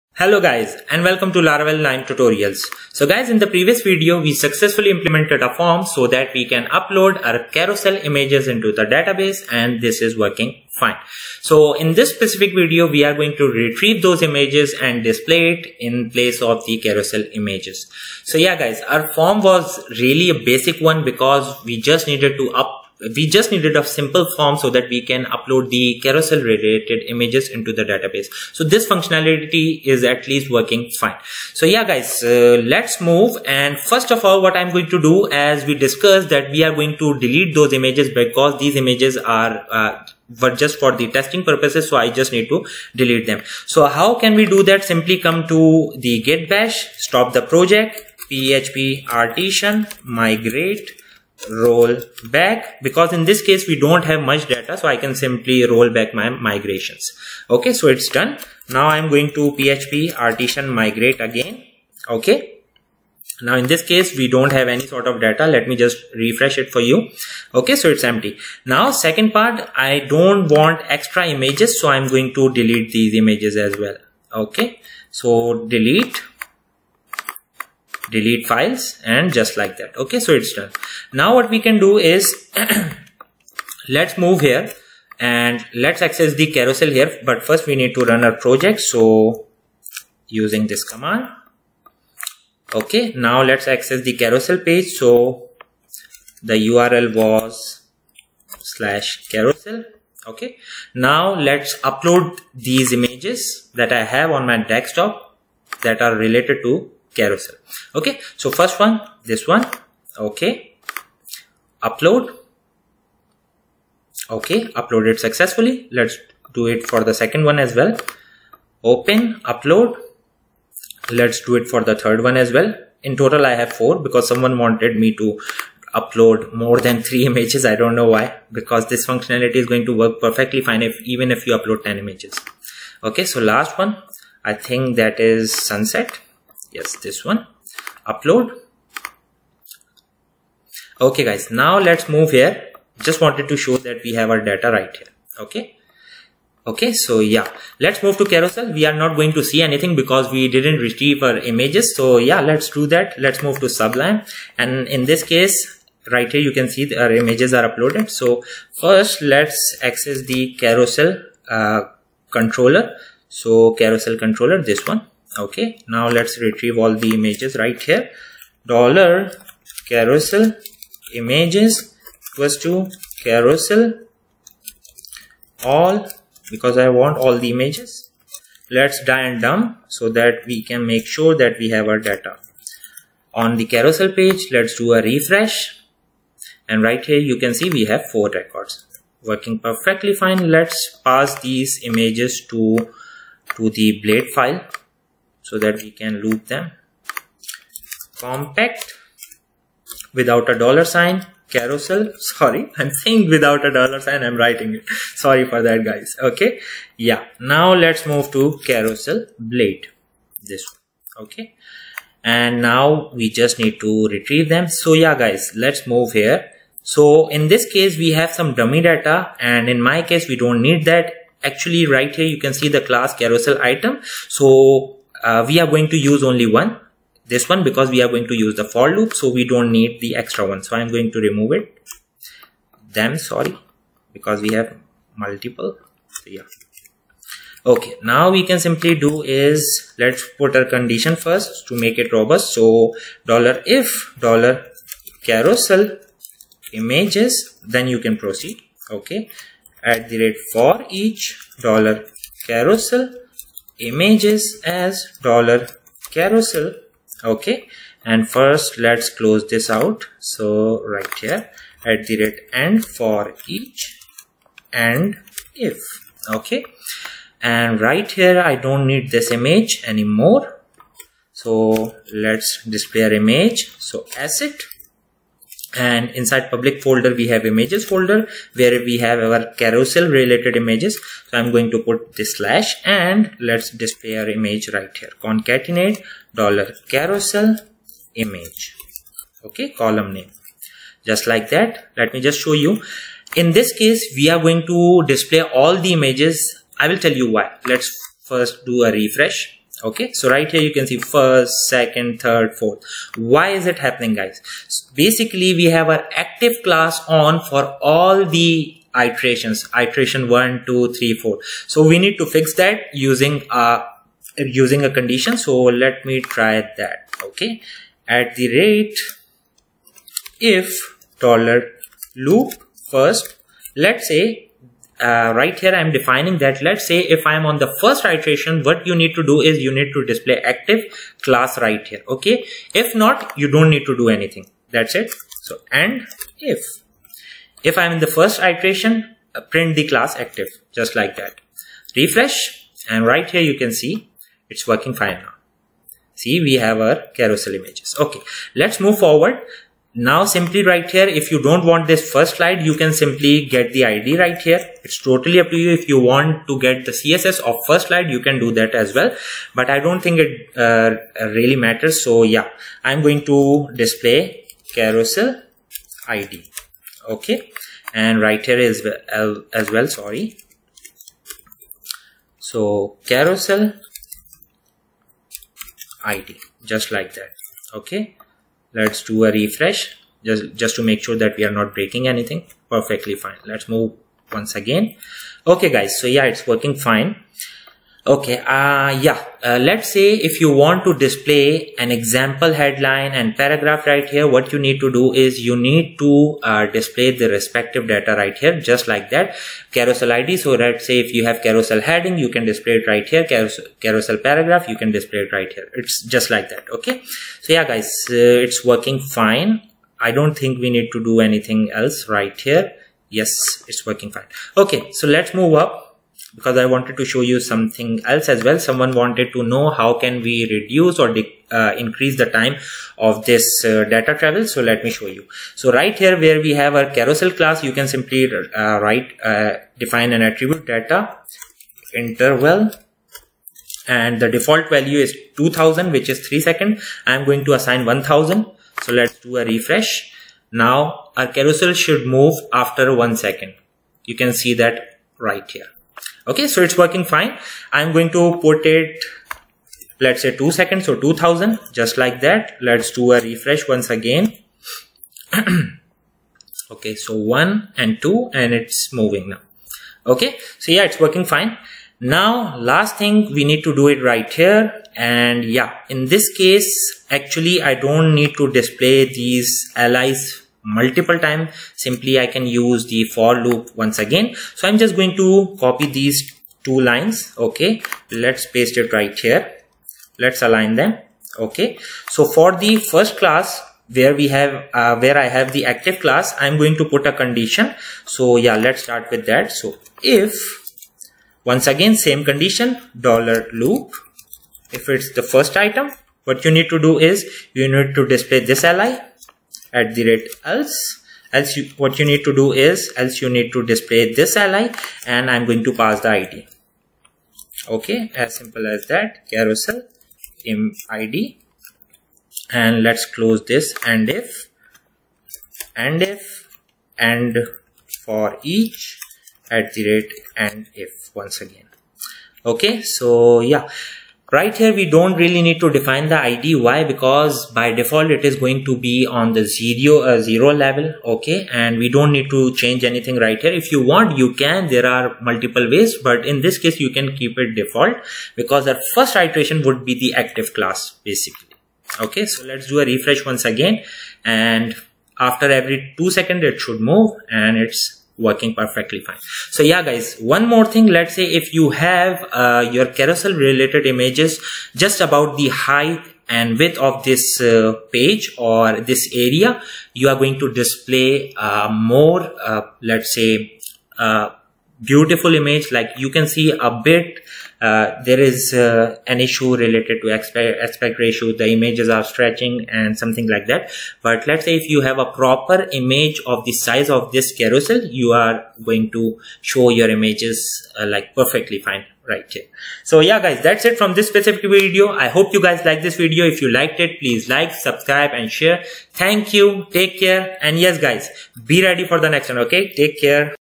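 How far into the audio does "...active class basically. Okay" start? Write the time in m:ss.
9:00.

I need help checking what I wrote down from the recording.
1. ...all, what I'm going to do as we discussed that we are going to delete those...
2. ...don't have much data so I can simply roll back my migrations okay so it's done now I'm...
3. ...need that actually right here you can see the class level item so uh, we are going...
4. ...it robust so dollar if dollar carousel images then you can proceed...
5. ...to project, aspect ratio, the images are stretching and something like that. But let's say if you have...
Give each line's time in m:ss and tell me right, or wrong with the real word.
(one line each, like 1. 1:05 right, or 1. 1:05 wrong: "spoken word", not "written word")
1. 0:34 right
2. 0:53 right
3. 3:40 wrong: "carousel", not "level"
4. 4:01 right
5. 9:30 wrong: "aspect", not "project".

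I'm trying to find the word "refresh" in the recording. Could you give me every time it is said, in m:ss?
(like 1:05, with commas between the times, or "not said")
1:06, 3:05, 4:58, 5:41, 6:19, 7:19, 7:33, 9:02.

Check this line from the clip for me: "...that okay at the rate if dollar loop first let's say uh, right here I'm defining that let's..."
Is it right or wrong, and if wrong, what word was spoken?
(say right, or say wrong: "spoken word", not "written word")
right.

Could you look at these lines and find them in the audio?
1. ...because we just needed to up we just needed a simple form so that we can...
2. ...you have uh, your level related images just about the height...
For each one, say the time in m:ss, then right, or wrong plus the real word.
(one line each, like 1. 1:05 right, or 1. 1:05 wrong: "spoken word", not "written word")
1. 0:21 right
2. 9:11 wrong: "carousel", not "level".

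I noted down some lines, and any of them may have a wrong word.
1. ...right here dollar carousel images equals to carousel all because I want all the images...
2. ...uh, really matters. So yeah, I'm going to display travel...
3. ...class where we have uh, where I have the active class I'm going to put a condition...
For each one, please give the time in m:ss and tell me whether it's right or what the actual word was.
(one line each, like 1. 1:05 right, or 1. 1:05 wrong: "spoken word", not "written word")
1. 2:47 right
2. 6:00 wrong: "carousel", not "travel"
3. 8:03 right.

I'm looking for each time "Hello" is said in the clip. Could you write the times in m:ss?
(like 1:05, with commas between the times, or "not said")
0:00.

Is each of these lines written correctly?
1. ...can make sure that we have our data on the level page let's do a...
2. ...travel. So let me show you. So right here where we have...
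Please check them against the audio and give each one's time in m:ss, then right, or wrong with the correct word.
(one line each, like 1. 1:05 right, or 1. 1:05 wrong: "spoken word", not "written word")
1. 3:00 wrong: "carousel", not "level"
2. 7:04 right.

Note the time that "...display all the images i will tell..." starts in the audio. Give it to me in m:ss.
4:55.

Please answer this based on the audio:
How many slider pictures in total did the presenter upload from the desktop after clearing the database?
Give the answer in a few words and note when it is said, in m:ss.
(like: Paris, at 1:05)
4, at 2:03.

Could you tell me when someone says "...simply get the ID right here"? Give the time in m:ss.
5:52.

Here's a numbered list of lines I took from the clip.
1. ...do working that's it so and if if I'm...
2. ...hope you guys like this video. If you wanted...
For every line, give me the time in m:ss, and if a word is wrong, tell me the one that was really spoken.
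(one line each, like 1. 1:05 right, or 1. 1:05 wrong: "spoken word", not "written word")
1. 5:33 wrong: "anything", not "working"
2. 9:45 wrong: "liked", not "wanted".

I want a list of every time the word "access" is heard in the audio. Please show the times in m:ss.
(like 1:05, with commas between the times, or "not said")
1:26, 1:33, 2:39.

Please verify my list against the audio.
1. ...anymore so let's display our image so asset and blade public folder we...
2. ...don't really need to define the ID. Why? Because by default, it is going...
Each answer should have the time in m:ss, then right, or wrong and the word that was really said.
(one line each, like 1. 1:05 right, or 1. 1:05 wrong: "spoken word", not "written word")
1. 4:29 wrong: "inside", not "blade"
2. 8:44 right.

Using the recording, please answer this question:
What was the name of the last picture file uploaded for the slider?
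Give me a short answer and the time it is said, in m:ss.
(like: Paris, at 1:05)
sunset, at 2:15.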